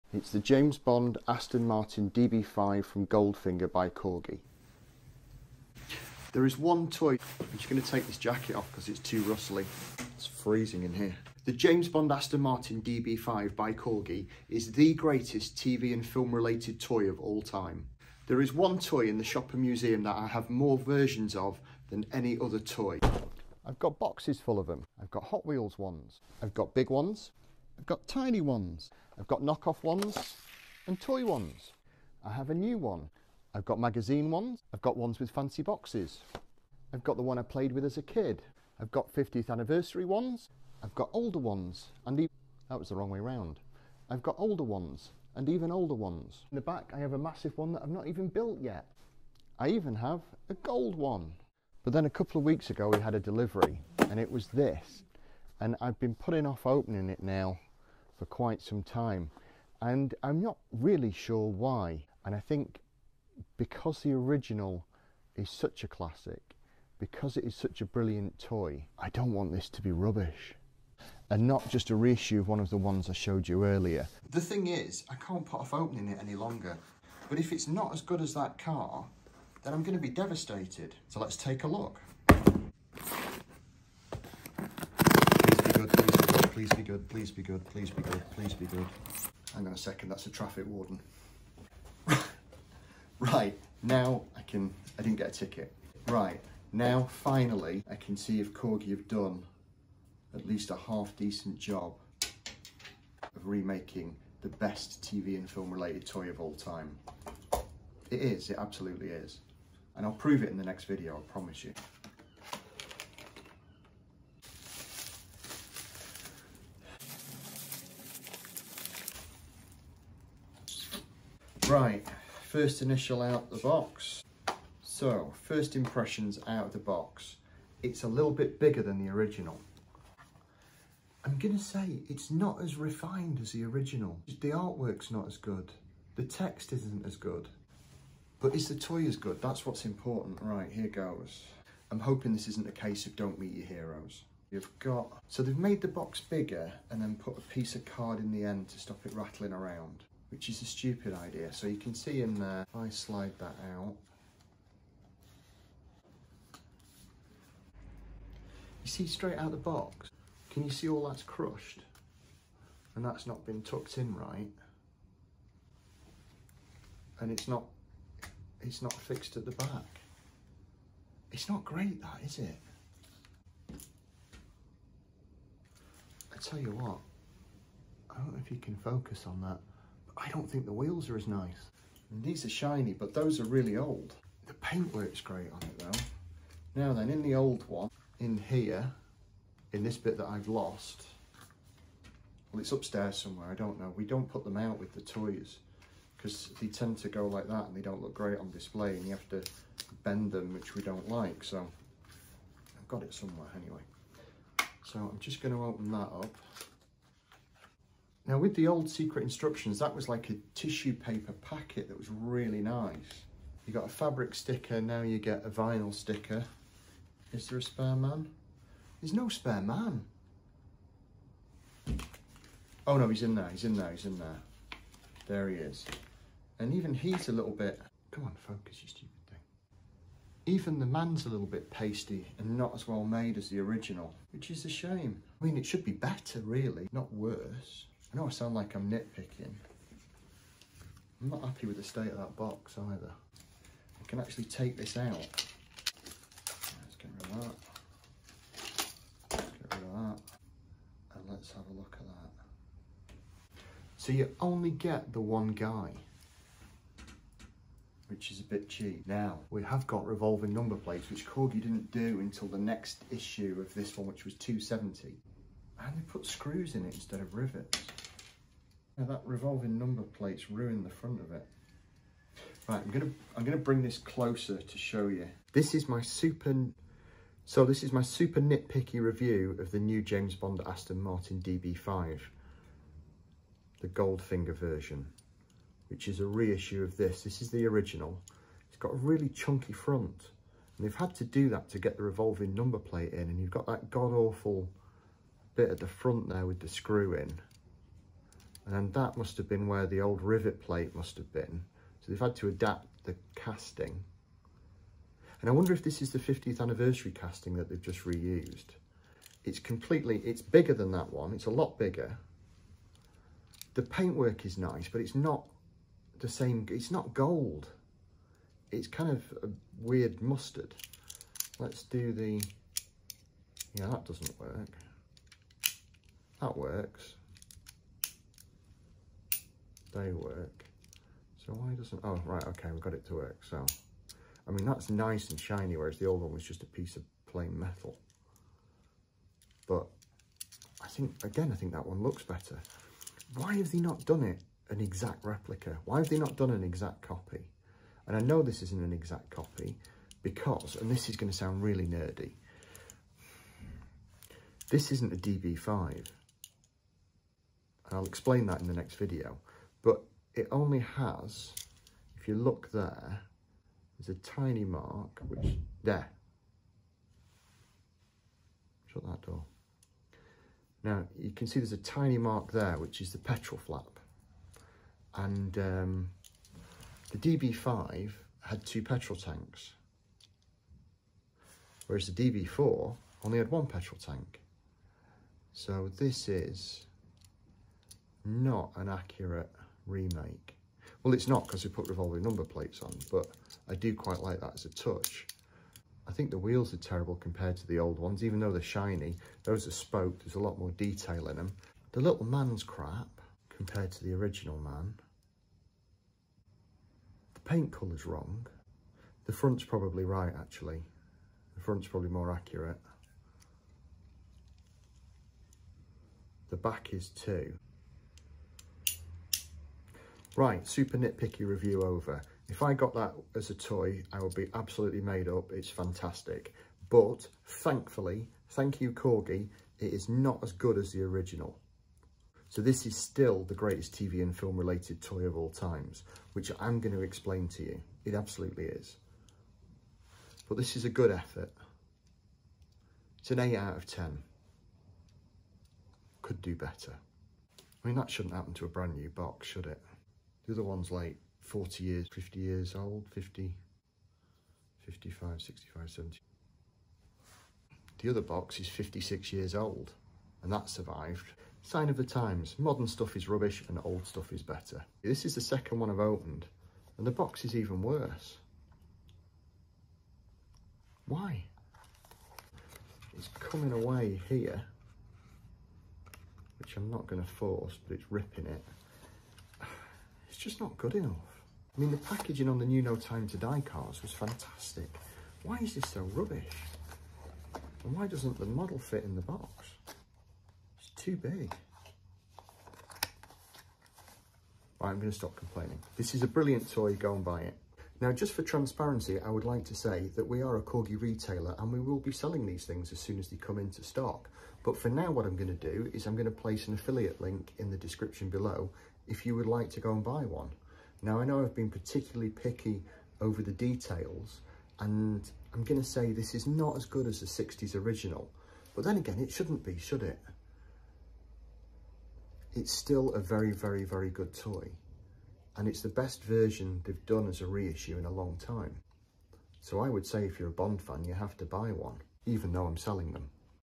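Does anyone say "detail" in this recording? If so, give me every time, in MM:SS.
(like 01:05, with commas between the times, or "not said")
06:40, 08:33.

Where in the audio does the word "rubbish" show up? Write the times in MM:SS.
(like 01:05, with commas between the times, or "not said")
01:09, 07:43, 08:06.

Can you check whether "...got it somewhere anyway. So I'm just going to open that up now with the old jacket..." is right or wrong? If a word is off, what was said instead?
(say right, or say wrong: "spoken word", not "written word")
wrong: "secret", not "jacket".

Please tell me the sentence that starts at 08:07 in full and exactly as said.
And why doesn't the model fit in the box?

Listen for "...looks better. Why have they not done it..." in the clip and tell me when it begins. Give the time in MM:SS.
05:42.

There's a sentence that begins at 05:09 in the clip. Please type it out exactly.
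It's completely, it's bigger than that one.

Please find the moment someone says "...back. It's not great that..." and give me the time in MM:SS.
02:49.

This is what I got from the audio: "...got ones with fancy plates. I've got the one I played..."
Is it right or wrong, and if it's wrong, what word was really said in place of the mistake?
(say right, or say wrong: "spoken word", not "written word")
wrong: "boxes", not "plates".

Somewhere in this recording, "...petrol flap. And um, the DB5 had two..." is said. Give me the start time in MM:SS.
06:13.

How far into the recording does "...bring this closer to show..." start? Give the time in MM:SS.
04:33.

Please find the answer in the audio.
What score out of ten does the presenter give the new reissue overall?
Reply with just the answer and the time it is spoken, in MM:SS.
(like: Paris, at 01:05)
8, at 07:23.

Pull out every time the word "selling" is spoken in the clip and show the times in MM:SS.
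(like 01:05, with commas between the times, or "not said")
08:22, 08:52.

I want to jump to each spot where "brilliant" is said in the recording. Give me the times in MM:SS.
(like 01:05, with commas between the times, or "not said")
01:07, 08:16.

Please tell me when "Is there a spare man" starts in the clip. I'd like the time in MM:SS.
03:37.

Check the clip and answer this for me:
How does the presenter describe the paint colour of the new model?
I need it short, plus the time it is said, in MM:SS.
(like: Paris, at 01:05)
Weird mustard, at 05:19.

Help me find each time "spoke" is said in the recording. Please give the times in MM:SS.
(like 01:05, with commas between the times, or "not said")
06:39.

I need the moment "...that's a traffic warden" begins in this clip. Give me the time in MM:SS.
01:30.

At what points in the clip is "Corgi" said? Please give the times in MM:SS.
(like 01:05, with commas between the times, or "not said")
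00:03, 00:13, 01:38, 04:21, 07:08, 08:20.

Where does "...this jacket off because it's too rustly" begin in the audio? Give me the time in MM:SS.
00:08.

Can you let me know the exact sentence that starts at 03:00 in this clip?
I don't think the wheels are as nice.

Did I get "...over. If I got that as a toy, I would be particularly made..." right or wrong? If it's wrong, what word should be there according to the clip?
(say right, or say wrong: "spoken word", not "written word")
wrong: "absolutely", not "particularly".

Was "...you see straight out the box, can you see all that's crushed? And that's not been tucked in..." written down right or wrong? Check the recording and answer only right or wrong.
right.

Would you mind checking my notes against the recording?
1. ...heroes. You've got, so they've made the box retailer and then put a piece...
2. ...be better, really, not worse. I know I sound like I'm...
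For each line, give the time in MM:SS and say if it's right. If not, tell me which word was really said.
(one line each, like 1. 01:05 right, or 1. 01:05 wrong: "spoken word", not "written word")
1. 02:23 wrong: "bigger", not "retailer"
2. 03:55 right.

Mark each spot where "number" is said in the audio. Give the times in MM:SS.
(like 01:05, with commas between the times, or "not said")
04:20, 04:29, 04:52, 06:32.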